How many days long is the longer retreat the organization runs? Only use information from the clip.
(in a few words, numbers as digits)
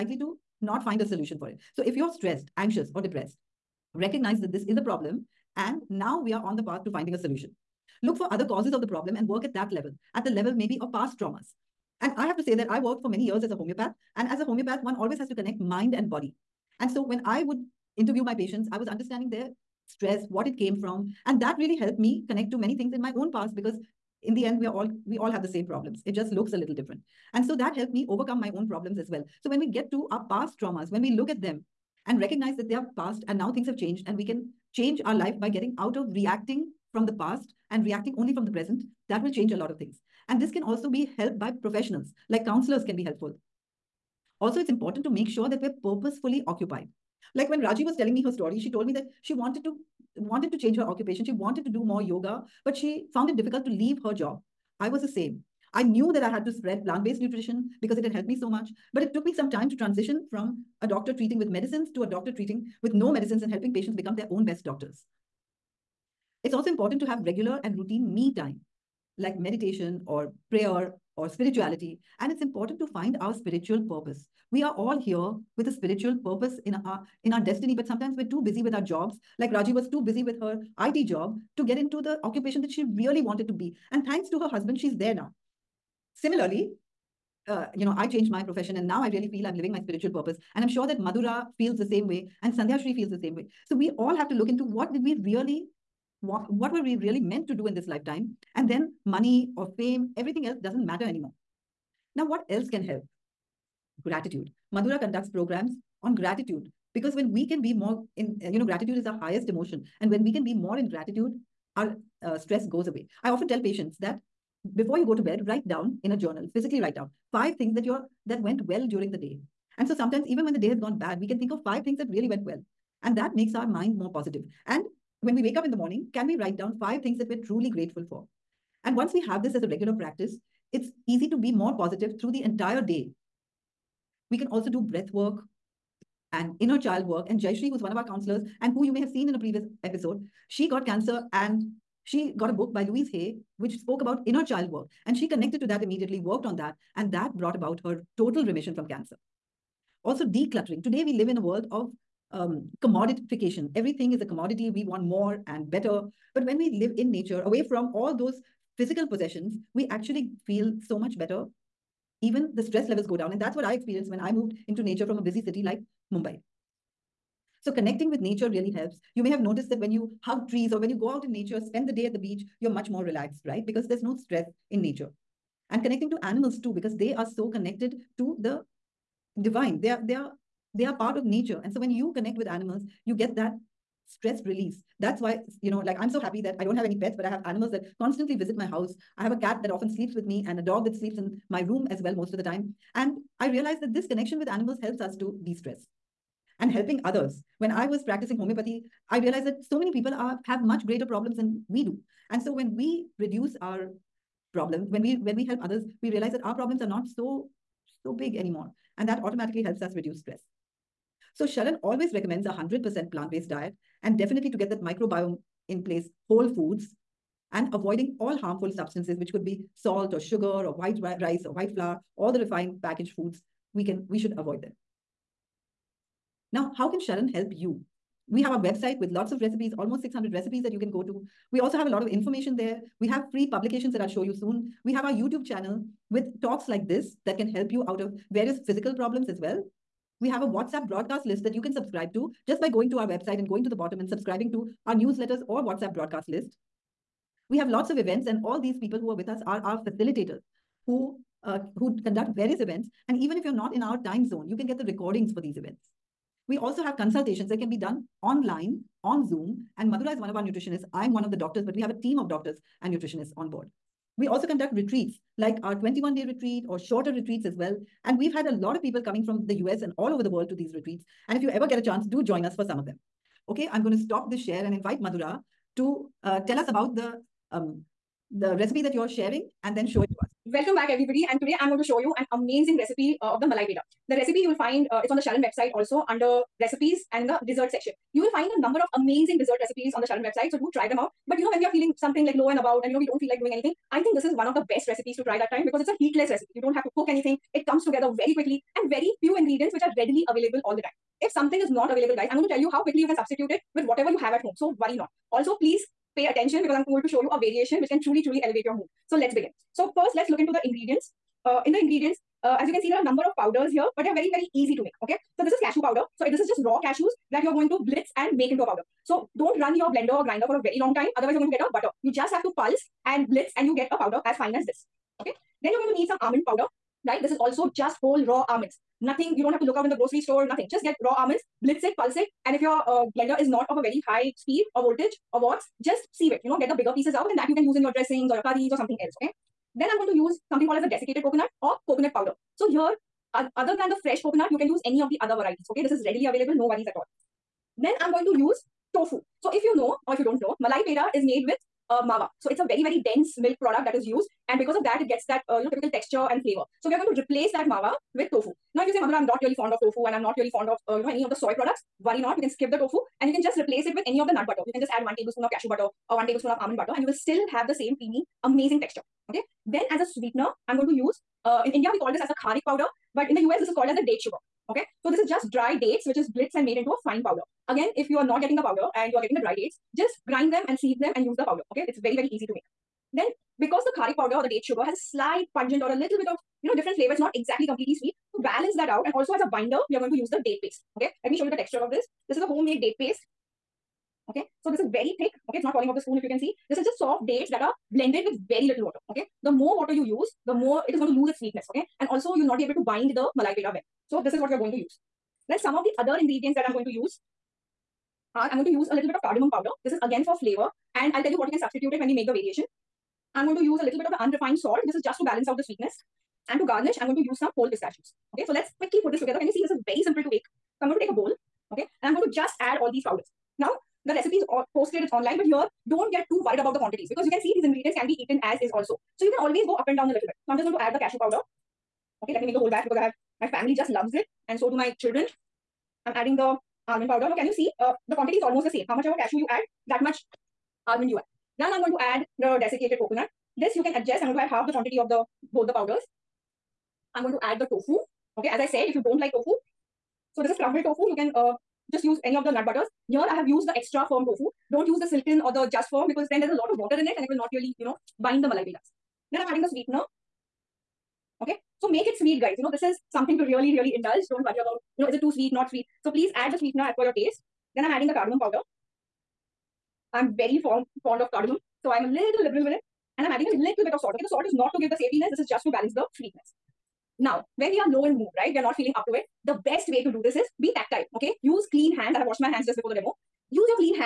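21.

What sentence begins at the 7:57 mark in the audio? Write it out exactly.
Now, when we are low in mood, right?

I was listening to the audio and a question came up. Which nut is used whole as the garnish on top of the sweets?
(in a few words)
pistachios.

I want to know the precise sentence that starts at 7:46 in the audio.
So please add the sweetener as per your taste.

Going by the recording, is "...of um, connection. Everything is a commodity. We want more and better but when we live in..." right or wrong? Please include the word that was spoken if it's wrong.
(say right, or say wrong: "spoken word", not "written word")
wrong: "commodification", not "connection".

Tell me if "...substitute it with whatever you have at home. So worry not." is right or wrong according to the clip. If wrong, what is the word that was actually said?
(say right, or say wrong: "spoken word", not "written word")
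right.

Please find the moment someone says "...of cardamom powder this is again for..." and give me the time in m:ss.
6:49.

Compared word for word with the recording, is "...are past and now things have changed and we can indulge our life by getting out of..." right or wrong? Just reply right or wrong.
wrong.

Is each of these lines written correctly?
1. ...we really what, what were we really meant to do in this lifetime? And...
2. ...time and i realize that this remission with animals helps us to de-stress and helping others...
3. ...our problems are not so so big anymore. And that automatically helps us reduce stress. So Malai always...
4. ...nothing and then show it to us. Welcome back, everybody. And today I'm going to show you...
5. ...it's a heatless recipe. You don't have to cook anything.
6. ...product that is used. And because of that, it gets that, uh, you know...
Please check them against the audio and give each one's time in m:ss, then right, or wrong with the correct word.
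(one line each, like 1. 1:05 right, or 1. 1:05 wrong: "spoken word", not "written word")
1. 1:35 right
2. 3:12 wrong: "connection", not "remission"
3. 3:26 wrong: "Sharan", not "Malai"
4. 4:39 wrong: "sharing", not "nothing"
5. 4:55 right
6. 5:53 right.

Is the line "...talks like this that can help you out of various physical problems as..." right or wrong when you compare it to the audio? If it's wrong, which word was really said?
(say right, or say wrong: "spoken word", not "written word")
right.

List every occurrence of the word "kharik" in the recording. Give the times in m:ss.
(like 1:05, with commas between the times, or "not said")
6:12, 6:23.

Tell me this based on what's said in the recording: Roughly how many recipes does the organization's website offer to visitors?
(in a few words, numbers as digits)
600.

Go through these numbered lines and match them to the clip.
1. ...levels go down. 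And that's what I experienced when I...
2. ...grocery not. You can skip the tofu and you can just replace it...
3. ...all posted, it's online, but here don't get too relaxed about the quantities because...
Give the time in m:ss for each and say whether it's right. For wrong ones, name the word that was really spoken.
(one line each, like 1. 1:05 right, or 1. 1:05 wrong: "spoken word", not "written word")
1. 2:42 right
2. 6:02 wrong: "worry", not "grocery"
3. 7:04 wrong: "worried", not "relaxed".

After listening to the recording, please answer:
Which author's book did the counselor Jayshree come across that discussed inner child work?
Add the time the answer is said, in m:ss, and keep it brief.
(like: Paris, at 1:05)
Louise Hay, at 2:22.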